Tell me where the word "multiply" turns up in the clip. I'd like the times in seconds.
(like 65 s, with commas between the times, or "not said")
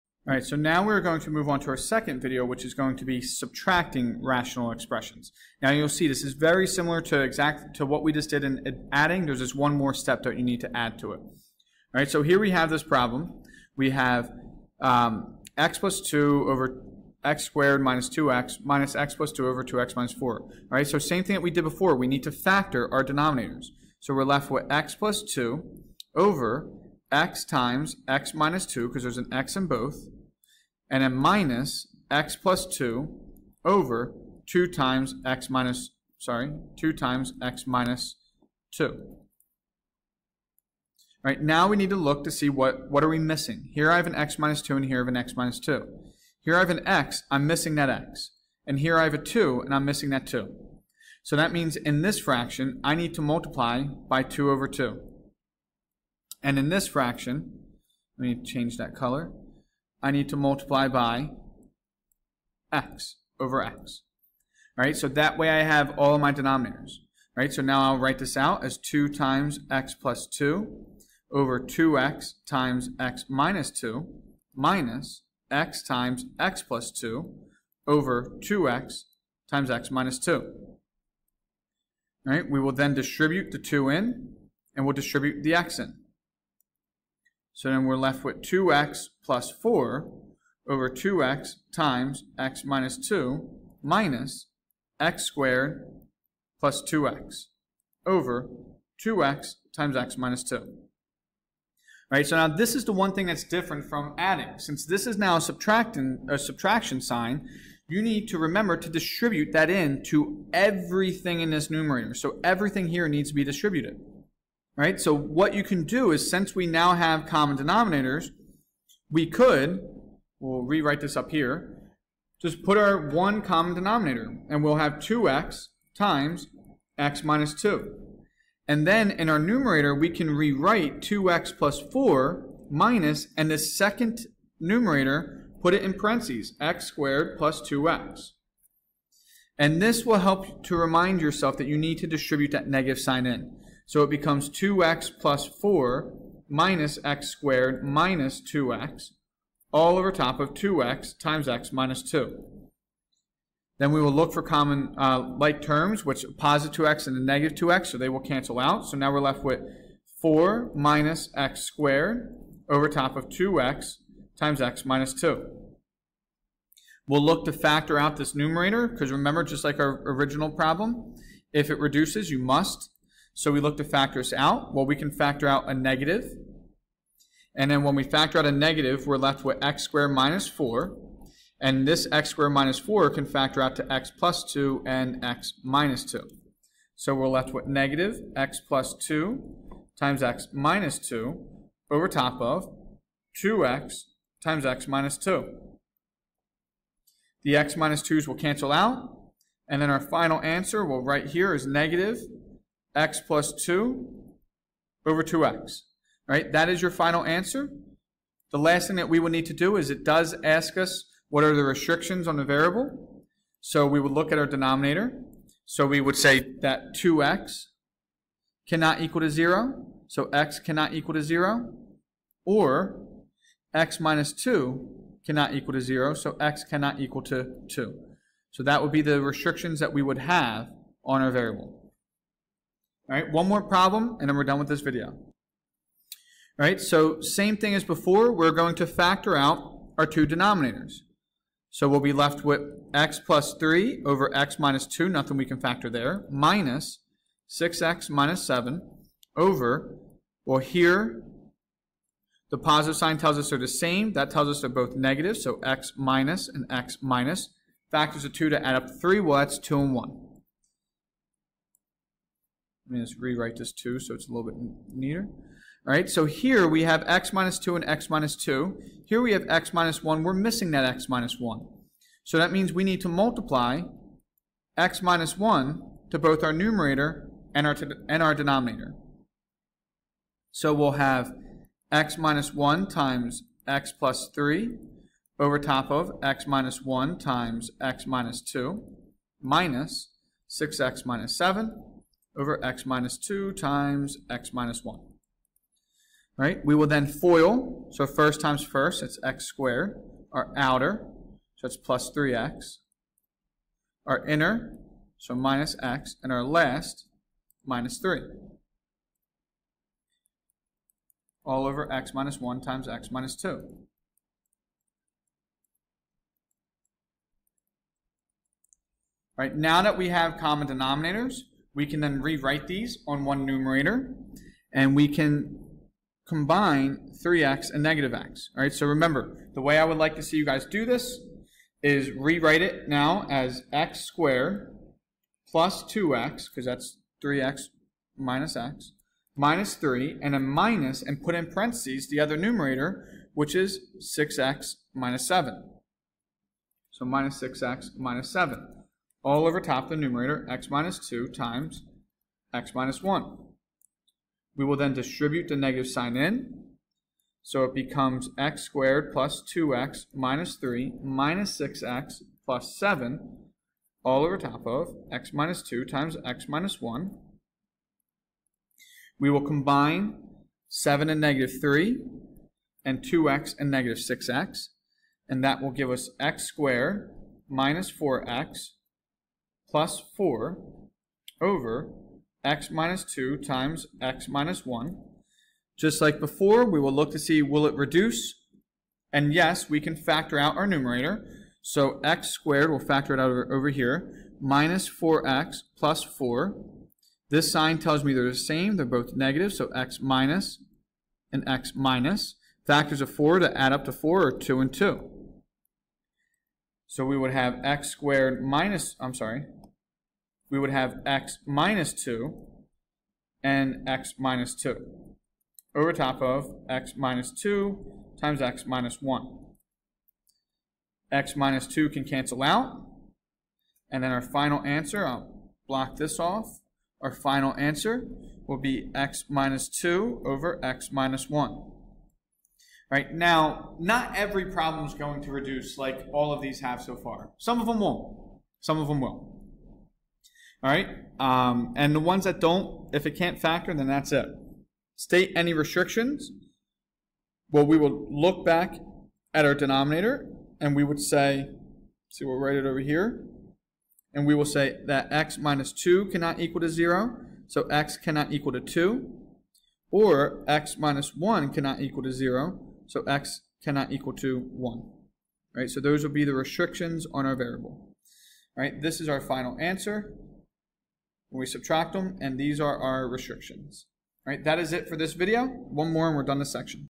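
53 s, 60 s, 273 s.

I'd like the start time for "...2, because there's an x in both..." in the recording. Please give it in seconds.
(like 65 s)
28 s.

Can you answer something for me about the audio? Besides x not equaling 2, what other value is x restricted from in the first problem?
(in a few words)
0.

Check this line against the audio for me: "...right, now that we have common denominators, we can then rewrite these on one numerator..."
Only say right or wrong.
right.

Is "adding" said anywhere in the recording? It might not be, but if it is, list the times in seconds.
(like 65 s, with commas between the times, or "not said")
8 s, 104 s.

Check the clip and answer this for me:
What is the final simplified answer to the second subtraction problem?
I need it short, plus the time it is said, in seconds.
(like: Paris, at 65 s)
(x-2)/(x-1), at 428 s.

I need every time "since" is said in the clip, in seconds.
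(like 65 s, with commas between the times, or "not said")
104 s, 116 s.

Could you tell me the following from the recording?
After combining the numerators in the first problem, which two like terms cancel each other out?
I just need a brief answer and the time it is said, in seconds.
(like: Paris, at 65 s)
2x and -2x, at 156 s.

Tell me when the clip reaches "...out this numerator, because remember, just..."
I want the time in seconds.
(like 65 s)
167 s.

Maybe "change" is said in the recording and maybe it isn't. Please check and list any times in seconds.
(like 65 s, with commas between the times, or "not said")
58 s.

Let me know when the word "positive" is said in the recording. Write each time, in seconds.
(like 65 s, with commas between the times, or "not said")
156 s, 252 s.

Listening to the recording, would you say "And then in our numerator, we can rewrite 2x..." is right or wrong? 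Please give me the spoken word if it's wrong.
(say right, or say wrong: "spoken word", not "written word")
right.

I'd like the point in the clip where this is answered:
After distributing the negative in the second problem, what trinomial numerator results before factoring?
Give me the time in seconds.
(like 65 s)
376 s.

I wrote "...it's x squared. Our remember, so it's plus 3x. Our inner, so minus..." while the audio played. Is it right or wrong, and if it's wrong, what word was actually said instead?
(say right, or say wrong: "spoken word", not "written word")
wrong: "outer", not "remember".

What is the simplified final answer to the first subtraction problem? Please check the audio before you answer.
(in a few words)
-(x+2)/(2x).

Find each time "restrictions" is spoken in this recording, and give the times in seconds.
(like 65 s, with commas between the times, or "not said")
211 s, 229 s, 445 s, 466 s, 473 s.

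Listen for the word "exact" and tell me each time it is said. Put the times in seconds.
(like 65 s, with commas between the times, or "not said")
7 s.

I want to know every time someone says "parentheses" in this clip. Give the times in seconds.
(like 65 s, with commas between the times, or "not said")
135 s, 341 s.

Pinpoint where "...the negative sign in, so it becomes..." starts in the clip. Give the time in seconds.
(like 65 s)
355 s.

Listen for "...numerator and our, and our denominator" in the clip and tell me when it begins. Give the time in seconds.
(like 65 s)
276 s.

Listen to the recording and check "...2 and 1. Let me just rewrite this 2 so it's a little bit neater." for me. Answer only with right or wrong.
right.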